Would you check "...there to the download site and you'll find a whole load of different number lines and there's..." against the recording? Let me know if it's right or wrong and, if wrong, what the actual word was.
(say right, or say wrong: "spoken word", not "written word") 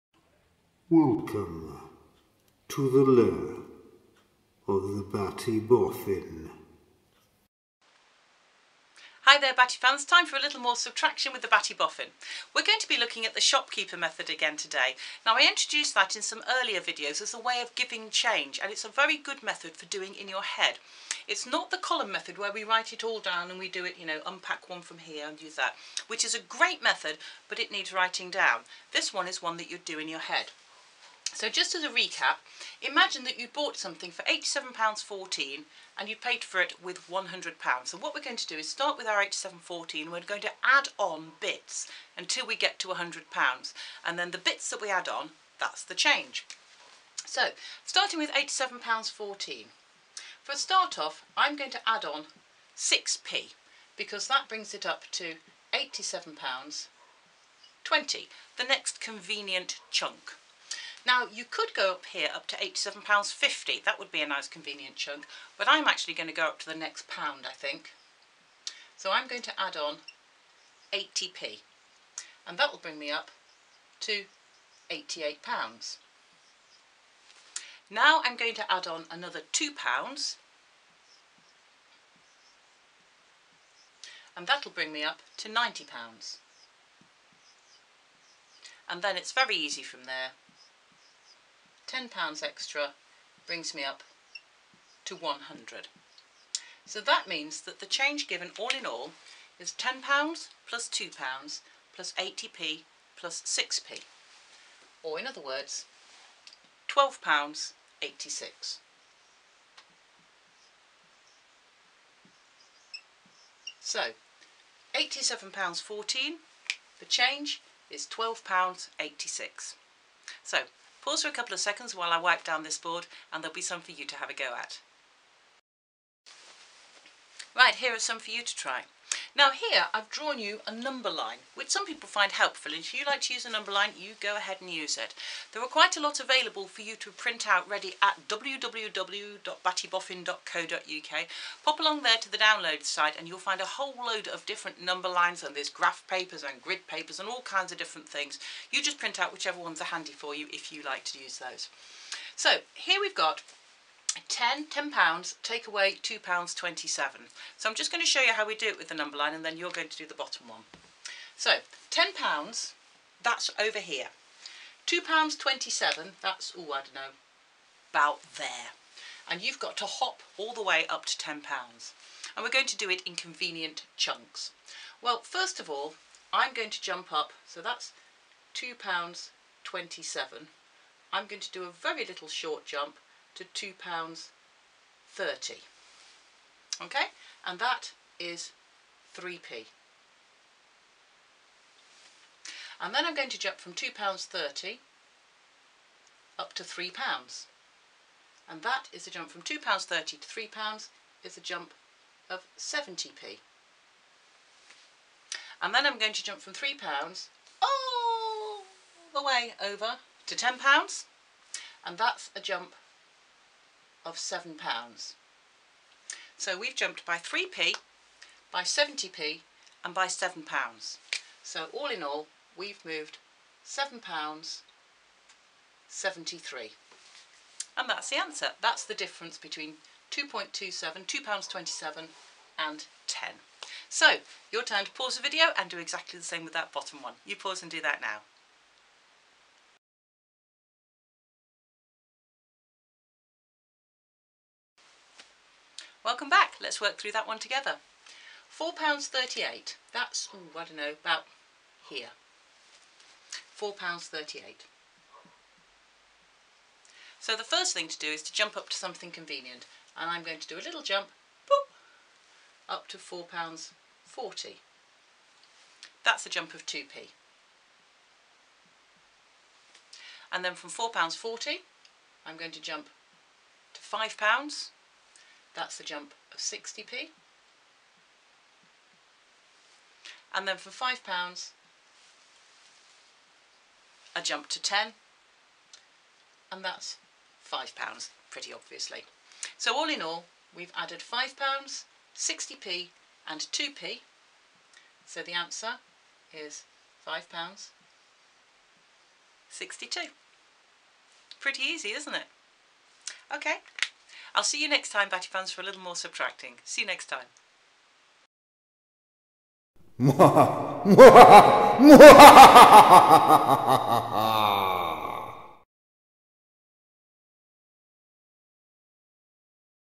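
right.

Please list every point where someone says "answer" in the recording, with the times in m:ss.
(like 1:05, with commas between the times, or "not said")
3:48, 4:55.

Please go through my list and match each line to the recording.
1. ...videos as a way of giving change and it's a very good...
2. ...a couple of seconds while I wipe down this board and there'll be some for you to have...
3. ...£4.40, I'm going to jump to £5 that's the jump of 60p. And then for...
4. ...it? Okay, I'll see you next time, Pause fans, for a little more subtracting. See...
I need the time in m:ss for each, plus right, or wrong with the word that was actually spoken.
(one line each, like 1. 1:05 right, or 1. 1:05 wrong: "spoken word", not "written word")
1. 0:16 right
2. 2:01 right
3. 4:30 right
4. 5:02 wrong: "Batty", not "Pause".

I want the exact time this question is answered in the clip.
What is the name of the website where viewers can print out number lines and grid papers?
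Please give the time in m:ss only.
2:18.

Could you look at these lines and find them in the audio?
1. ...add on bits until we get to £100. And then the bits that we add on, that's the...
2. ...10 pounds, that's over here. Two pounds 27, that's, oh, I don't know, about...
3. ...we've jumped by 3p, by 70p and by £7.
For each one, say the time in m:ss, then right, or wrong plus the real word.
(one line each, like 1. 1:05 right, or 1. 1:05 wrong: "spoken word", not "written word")
1. 0:40 right
2. 2:41 right
3. 3:36 right.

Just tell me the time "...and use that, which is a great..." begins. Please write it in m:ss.
0:25.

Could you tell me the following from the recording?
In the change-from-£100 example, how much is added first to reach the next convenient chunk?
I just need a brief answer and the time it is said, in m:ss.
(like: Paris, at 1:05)
6p, at 0:52.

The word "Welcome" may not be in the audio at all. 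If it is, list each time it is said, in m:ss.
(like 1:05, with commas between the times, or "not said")
0:00, 4:06.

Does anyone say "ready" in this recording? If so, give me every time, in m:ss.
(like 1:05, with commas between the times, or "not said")
2:17.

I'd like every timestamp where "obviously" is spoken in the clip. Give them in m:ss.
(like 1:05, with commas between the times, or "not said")
4:48.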